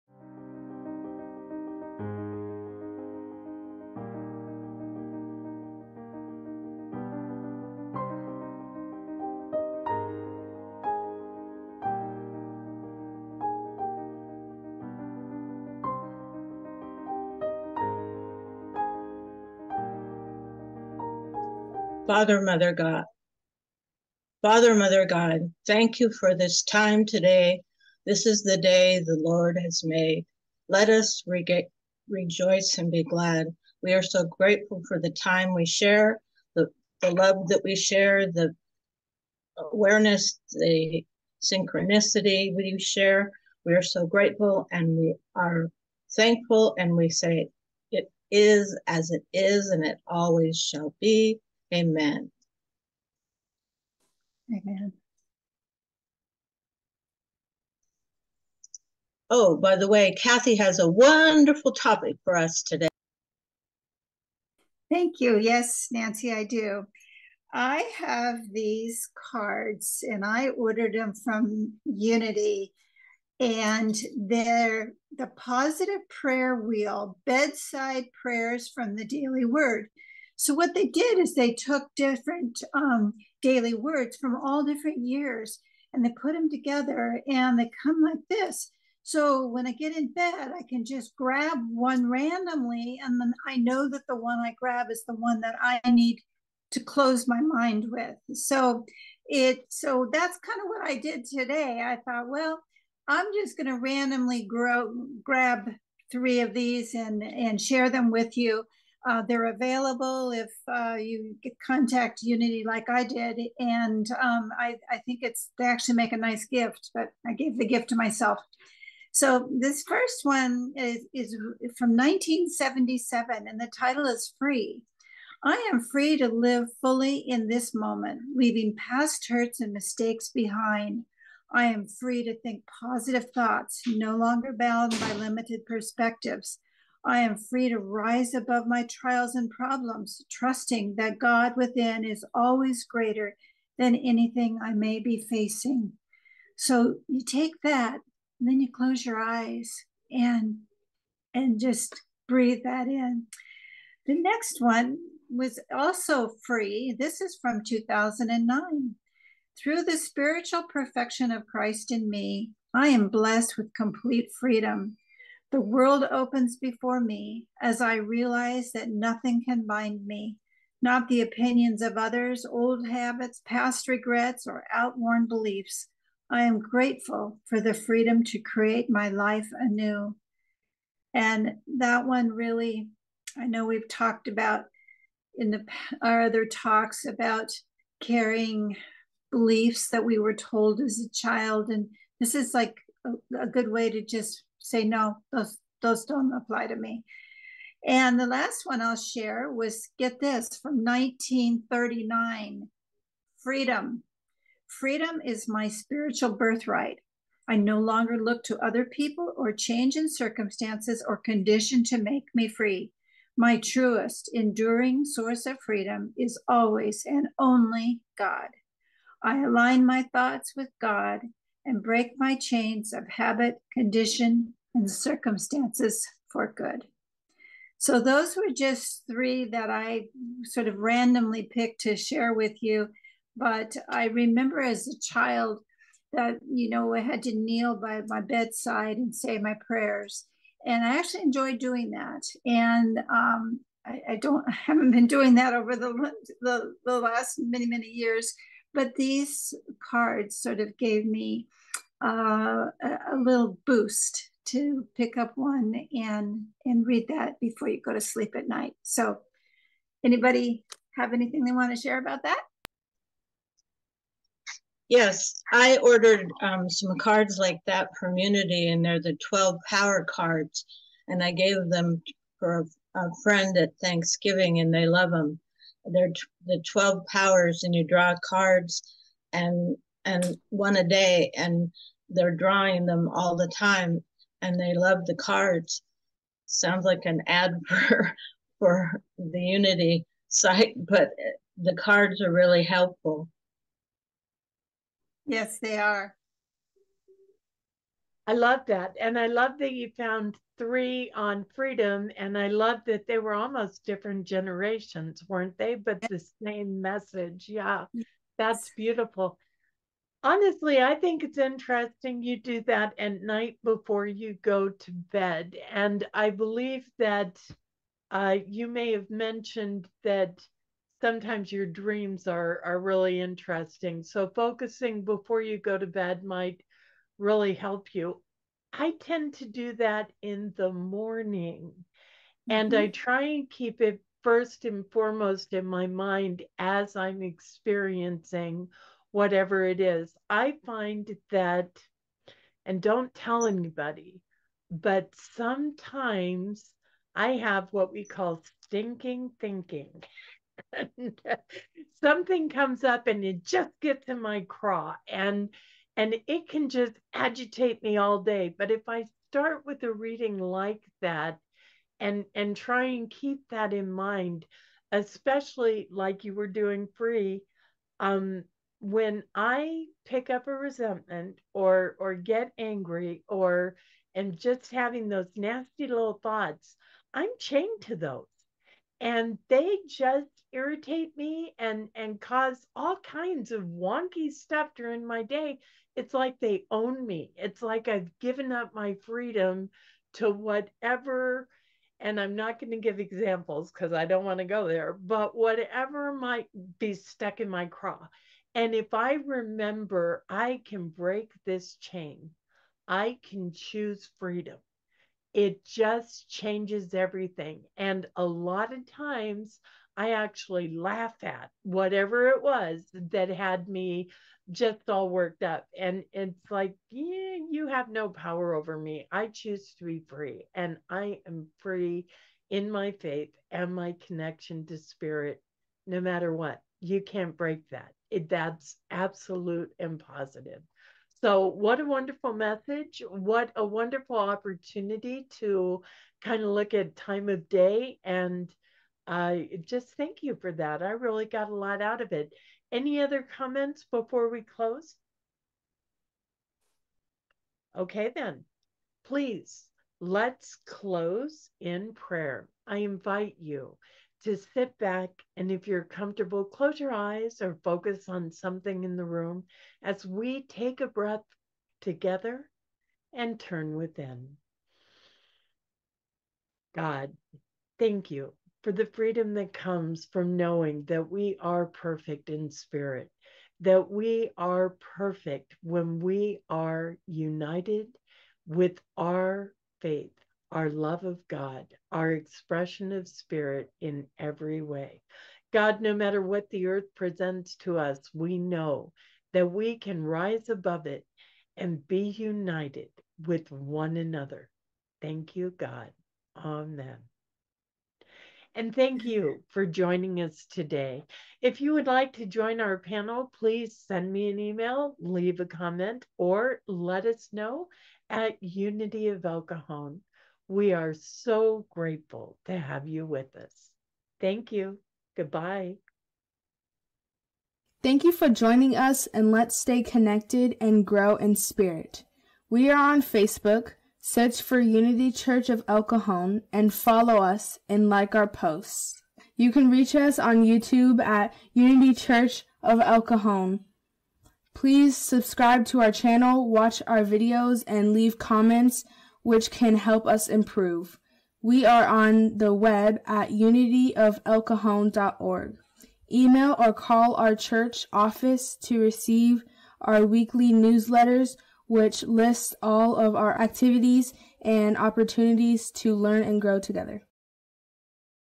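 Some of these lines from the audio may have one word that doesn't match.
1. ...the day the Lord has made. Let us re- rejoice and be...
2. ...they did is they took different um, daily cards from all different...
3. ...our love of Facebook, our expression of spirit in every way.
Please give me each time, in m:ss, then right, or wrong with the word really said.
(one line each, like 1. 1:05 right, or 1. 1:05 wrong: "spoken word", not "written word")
1. 0:28 right
2. 1:20 wrong: "words", not "cards"
3. 8:00 wrong: "God", not "Facebook".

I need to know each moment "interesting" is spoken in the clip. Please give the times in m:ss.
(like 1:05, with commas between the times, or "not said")
5:11, 5:23.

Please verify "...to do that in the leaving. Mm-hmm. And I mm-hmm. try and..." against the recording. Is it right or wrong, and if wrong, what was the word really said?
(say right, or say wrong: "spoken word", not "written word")
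wrong: "morning", not "leaving".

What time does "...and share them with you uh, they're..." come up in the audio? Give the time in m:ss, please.
1:47.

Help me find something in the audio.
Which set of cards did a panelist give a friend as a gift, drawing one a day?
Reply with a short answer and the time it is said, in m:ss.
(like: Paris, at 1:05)
12 power cards, at 4:29.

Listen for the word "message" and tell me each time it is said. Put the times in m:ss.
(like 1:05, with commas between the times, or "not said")
5:06, 7:12.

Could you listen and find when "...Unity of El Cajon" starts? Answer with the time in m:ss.
8:28.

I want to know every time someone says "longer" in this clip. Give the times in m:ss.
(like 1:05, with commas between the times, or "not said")
2:14, 3:27.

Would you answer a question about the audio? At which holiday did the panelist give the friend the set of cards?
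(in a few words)
Thanksgiving.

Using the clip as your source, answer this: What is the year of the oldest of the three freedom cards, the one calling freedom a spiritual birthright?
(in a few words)
1939.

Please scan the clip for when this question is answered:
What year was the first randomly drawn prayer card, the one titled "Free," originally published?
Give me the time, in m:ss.
2:01.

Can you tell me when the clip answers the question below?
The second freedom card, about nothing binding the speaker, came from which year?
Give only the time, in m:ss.
2:37.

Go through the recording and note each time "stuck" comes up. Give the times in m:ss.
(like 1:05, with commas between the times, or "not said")
6:36.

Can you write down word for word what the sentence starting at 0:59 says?
Oh, by the way, Cathy has a wonderful topic for us today.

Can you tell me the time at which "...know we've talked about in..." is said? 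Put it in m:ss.
3:03.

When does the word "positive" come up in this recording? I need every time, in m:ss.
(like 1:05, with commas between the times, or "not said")
1:15, 2:12, 7:09.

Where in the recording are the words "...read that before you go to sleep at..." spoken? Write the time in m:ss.
4:16.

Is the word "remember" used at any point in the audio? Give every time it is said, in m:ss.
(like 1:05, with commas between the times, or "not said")
3:54, 6:39.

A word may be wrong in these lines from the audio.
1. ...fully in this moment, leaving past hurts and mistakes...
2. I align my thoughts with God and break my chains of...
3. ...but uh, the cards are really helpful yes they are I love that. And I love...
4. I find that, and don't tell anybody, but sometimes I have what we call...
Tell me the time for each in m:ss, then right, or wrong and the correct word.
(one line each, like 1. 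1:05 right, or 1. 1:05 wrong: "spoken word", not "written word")
1. 2:06 right
2. 3:39 right
3. 4:50 right
4. 5:40 right.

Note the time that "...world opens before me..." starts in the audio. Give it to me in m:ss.
2:45.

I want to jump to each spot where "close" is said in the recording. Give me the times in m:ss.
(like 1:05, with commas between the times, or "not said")
1:36, 2:28, 7:24, 7:30, 7:36.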